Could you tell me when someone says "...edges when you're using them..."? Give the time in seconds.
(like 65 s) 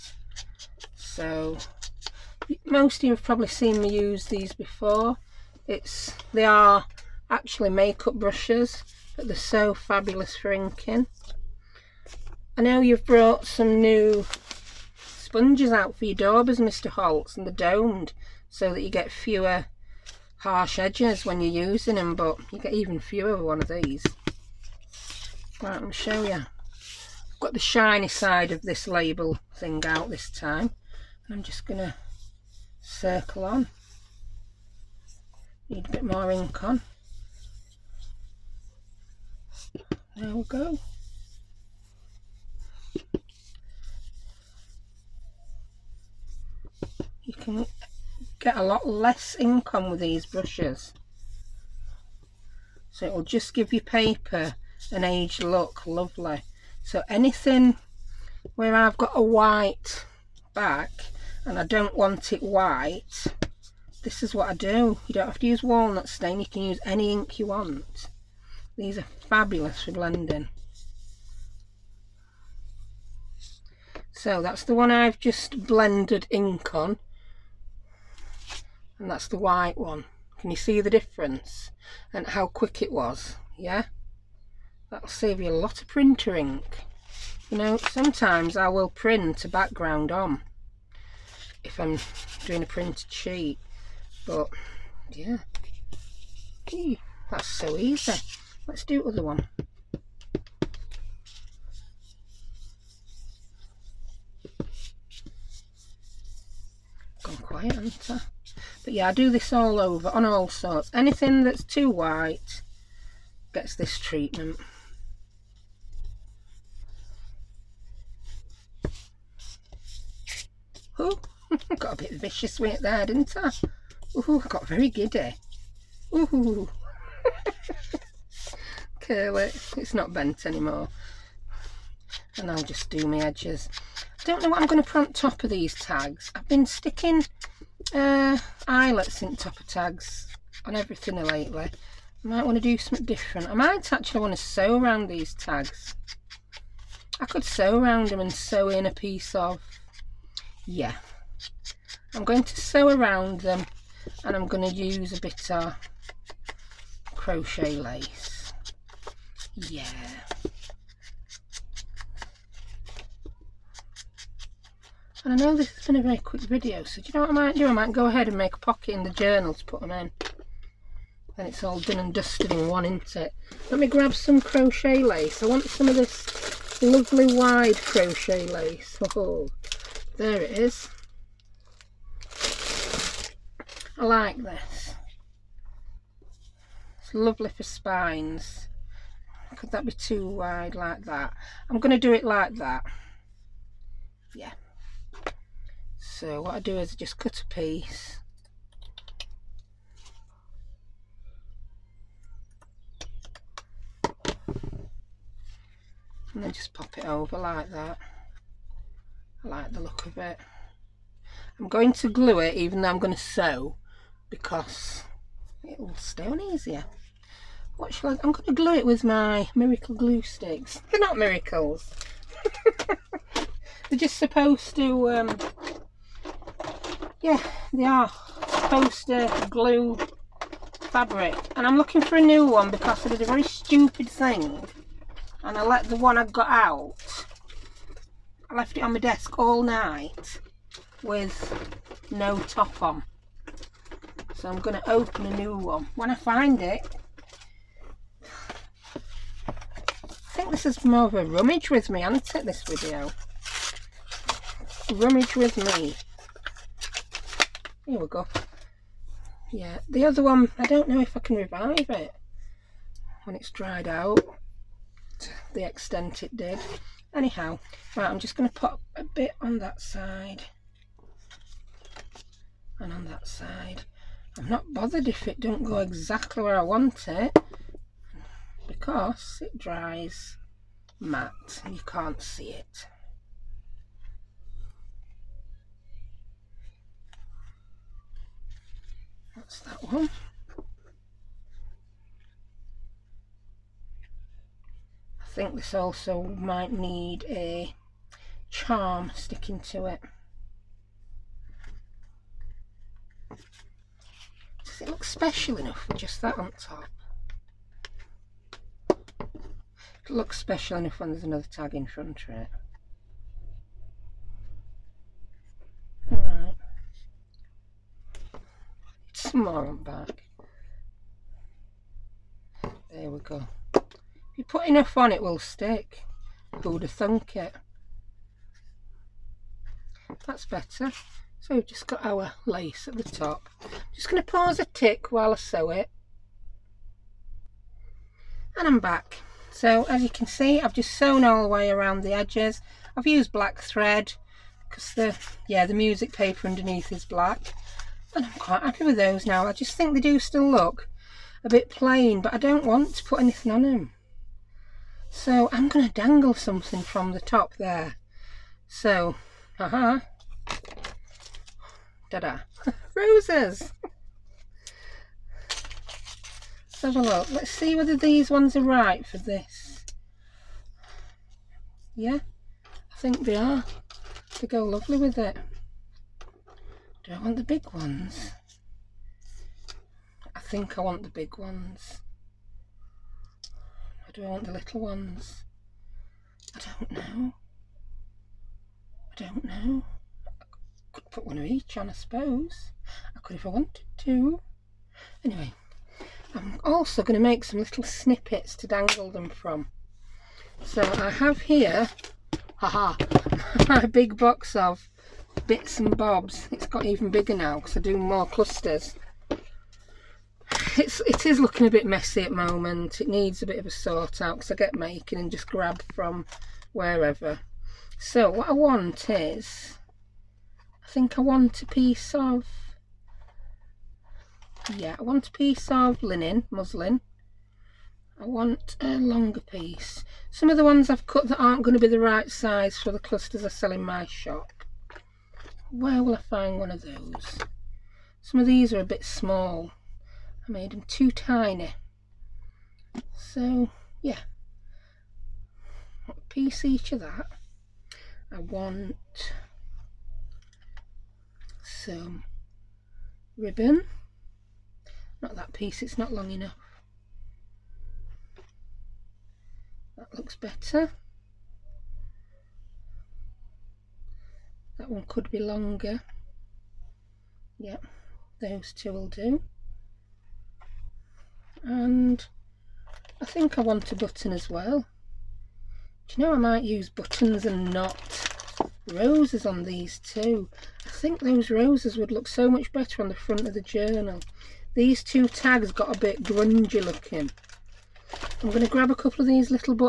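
20 s.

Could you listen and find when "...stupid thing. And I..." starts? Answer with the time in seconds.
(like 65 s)
233 s.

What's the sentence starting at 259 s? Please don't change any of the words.
Yeah, the other one, I don't know if I can revive it when it's dried out the extent it did.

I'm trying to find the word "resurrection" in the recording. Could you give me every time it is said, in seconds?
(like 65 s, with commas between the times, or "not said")
not said.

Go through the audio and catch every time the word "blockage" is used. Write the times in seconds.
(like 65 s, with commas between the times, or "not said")
not said.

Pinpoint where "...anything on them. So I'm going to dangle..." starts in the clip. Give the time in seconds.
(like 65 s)
353 s.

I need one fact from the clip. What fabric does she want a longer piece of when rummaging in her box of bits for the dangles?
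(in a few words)
Linen muslin.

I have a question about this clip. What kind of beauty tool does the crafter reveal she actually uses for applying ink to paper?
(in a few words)
Makeup brushes.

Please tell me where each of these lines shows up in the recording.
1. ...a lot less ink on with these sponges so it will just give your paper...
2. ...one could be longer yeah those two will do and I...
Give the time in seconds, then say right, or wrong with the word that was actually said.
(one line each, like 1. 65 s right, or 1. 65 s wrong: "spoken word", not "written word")
1. 48 s wrong: "brushes", not "sponges"
2. 464 s right.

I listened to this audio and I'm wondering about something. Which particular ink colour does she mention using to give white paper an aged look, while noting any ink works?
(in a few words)
Walnut stain.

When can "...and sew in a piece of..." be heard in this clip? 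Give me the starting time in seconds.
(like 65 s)
148 s.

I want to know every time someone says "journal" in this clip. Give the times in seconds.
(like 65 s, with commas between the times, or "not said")
169 s, 483 s.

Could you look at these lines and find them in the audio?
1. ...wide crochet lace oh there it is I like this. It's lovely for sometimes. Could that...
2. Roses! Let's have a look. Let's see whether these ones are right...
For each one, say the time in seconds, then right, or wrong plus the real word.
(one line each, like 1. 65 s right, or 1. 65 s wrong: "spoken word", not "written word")
1. 177 s wrong: "spines", not "sometimes"
2. 362 s right.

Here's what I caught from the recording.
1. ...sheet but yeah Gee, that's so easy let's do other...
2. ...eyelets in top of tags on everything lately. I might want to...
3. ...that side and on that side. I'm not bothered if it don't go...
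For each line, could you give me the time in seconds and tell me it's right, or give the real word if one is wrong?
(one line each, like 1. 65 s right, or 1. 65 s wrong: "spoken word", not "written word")
1. 93 s right
2. 138 s right
3. 269 s right.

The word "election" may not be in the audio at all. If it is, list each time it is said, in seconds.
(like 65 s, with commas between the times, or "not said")
not said.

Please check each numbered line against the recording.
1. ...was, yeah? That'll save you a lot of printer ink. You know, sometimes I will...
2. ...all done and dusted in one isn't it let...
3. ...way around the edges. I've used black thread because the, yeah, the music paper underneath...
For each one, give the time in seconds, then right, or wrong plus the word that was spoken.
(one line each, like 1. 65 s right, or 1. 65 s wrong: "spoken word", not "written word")
1. 82 s right
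2. 171 s right
3. 341 s right.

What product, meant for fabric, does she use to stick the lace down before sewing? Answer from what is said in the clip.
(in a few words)
Miracle glue sticks.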